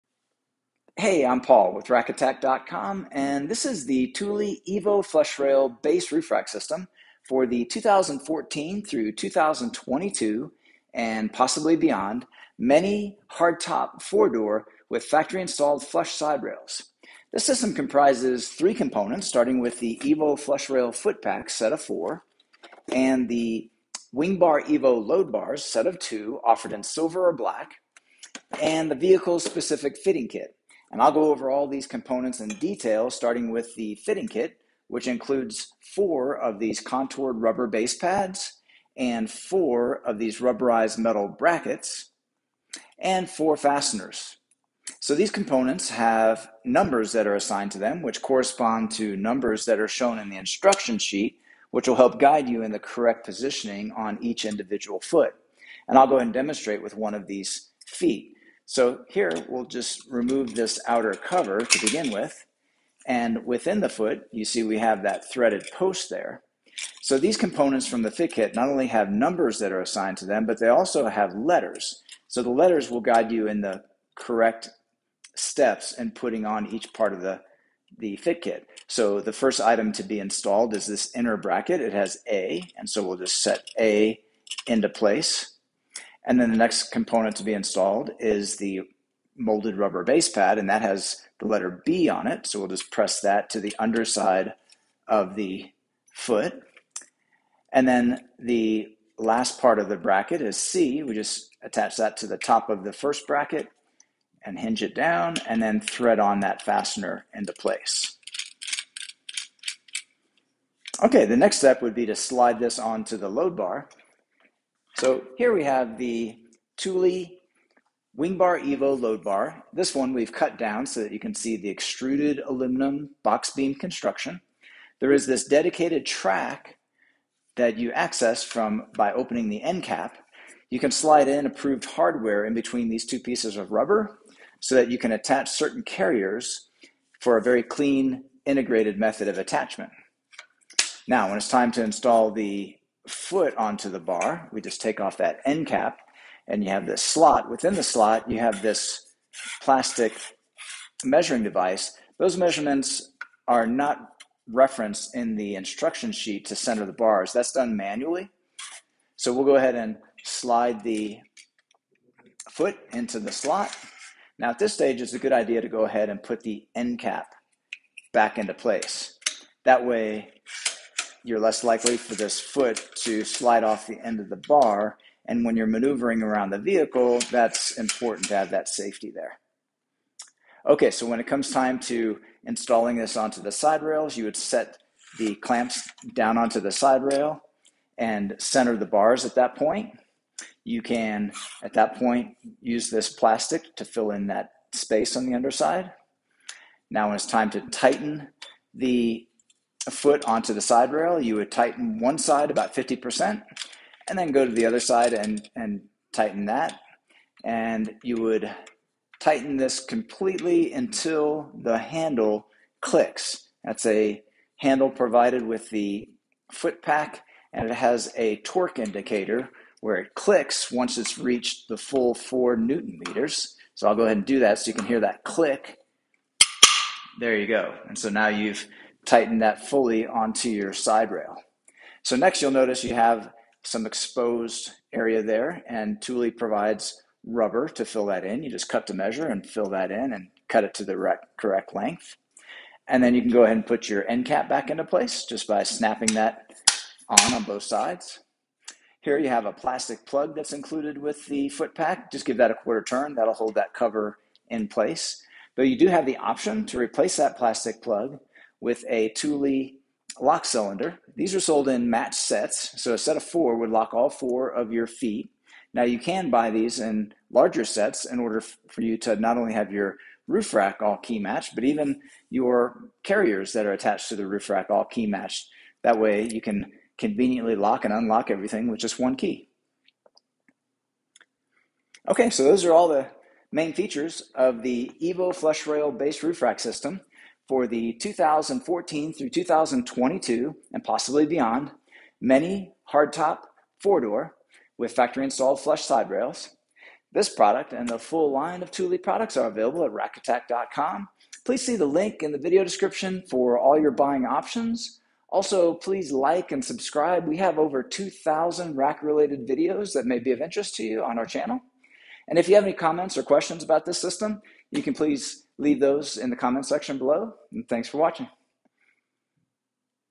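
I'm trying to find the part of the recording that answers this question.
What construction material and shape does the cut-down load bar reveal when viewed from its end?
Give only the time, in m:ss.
2:01.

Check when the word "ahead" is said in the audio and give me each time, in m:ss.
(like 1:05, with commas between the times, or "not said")
0:56, 2:39, 2:45, 3:44, 4:03.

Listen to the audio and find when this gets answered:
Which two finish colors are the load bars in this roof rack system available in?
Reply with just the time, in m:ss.
0:26.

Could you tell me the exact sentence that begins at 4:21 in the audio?
These are sold in match sets, so a set of four would lock all four of your feet.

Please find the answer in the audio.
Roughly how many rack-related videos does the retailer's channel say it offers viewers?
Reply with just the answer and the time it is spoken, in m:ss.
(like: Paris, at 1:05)
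over 2,000, at 5:07.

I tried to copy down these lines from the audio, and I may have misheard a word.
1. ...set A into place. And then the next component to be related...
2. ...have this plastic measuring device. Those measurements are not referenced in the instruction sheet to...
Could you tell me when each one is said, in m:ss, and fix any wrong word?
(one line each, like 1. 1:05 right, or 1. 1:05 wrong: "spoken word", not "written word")
1. 1:23 wrong: "installed", not "related"
2. 2:28 right.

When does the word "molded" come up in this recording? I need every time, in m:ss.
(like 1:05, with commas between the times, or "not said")
1:29.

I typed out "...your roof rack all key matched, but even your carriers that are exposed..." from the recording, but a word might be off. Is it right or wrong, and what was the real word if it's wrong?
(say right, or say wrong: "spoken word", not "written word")
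wrong: "attached", not "exposed".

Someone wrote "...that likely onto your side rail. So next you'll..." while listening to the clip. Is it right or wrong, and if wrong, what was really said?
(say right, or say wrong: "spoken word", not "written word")
wrong: "fully", not "likely".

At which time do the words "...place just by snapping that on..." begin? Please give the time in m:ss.
4:04.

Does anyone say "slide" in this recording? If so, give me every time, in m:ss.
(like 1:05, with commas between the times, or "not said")
1:52, 2:10, 2:40, 2:53.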